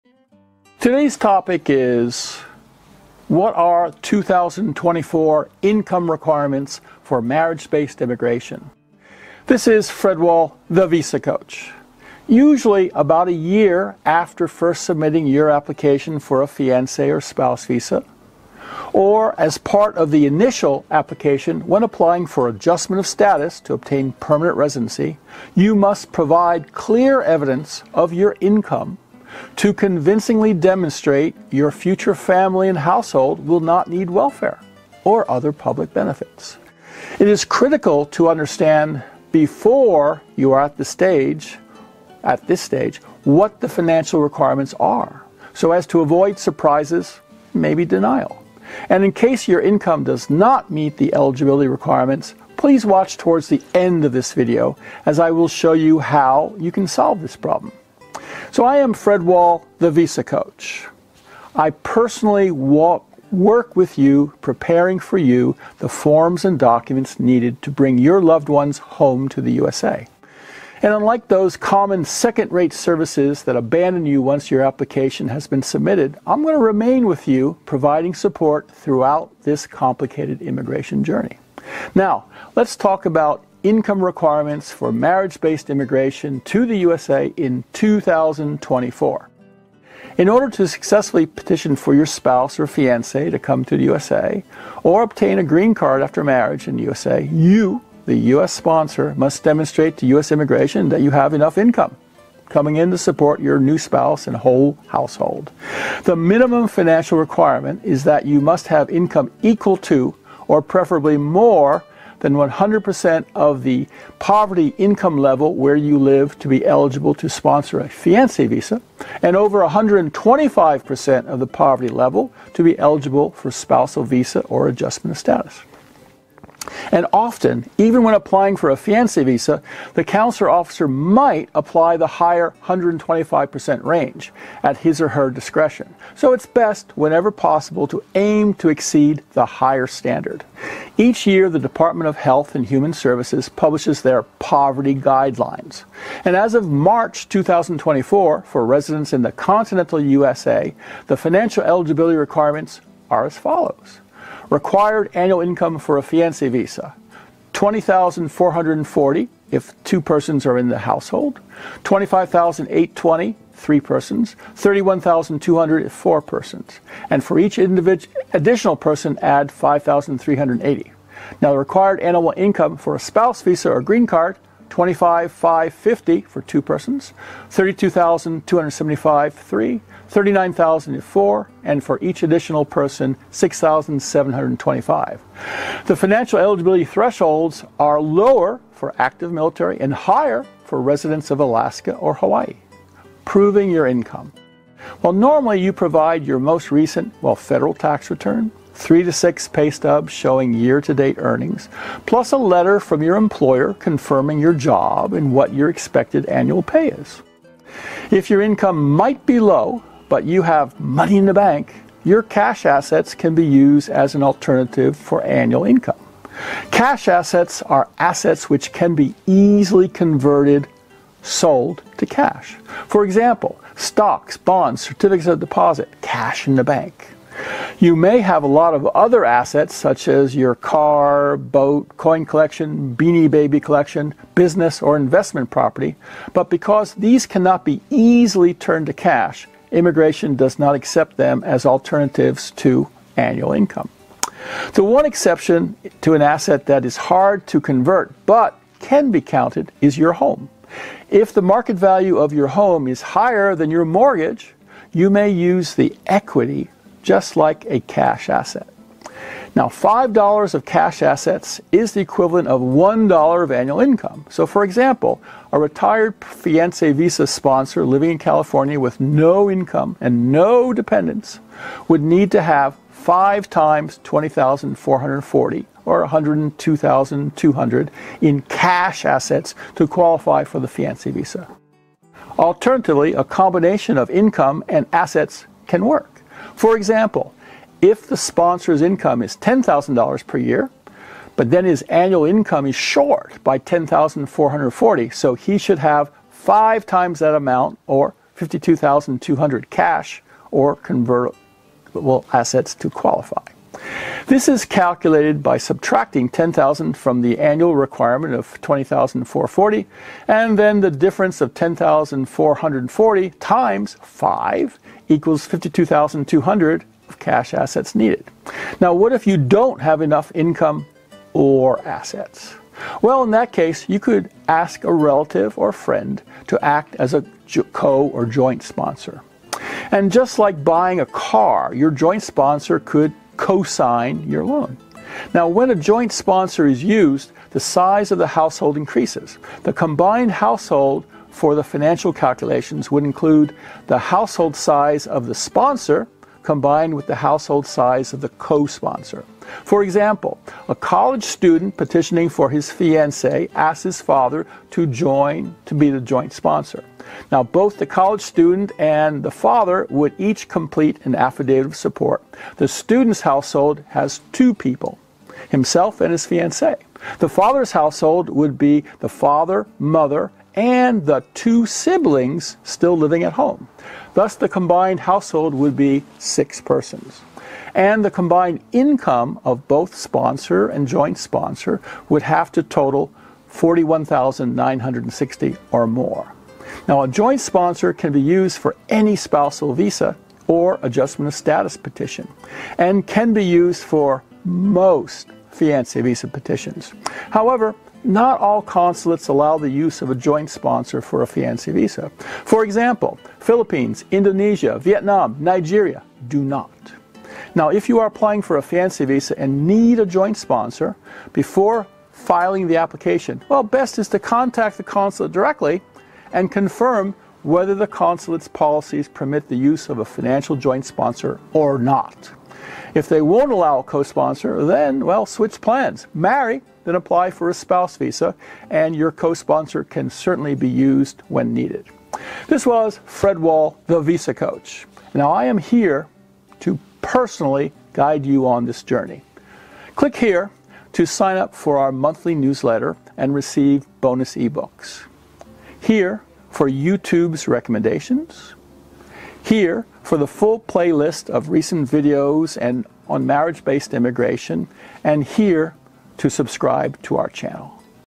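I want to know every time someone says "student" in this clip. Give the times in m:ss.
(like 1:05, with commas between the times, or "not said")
5:51, 5:58, 6:02.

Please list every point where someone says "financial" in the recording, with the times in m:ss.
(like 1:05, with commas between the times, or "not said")
0:43, 1:46, 2:31, 3:05, 5:41, 7:00.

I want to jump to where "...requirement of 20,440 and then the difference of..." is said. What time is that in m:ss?
5:07.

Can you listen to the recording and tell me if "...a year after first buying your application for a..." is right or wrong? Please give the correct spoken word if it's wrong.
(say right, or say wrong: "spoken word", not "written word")
wrong: "submitting", not "buying".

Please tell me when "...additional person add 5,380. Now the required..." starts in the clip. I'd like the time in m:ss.
2:47.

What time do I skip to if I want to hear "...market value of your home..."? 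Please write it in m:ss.
4:11.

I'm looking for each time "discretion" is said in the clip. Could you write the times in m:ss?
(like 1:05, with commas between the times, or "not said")
2:15.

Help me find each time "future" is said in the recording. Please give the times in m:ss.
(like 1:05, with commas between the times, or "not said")
0:31.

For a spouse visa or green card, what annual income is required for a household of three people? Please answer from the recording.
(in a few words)
$32,275.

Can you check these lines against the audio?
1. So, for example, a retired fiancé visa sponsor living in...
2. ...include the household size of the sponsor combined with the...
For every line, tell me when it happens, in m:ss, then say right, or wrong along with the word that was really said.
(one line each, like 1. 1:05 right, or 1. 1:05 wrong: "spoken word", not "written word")
1. 4:24 right
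2. 5:43 right.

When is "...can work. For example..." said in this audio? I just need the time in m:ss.
4:45.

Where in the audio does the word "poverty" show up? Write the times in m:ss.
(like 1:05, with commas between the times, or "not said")
1:54, 2:01, 2:24.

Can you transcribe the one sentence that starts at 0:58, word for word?
So I am Fred Wahl, the Visa Coach.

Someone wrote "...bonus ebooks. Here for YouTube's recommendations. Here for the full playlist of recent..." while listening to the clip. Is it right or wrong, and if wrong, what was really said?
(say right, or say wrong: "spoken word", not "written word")
right.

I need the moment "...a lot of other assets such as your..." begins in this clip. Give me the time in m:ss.
3:48.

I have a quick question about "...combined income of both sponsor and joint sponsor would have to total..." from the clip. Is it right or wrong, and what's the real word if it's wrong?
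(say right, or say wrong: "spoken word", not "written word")
right.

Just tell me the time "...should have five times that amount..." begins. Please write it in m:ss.
4:55.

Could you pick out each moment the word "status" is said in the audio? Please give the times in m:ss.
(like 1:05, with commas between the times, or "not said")
0:23, 2:05, 6:31.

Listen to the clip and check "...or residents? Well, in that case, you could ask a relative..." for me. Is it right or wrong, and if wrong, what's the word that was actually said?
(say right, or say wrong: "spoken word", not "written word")
wrong: "assets", not "residents".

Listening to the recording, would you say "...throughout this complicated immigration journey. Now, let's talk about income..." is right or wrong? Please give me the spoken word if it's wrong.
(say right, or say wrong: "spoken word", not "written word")
right.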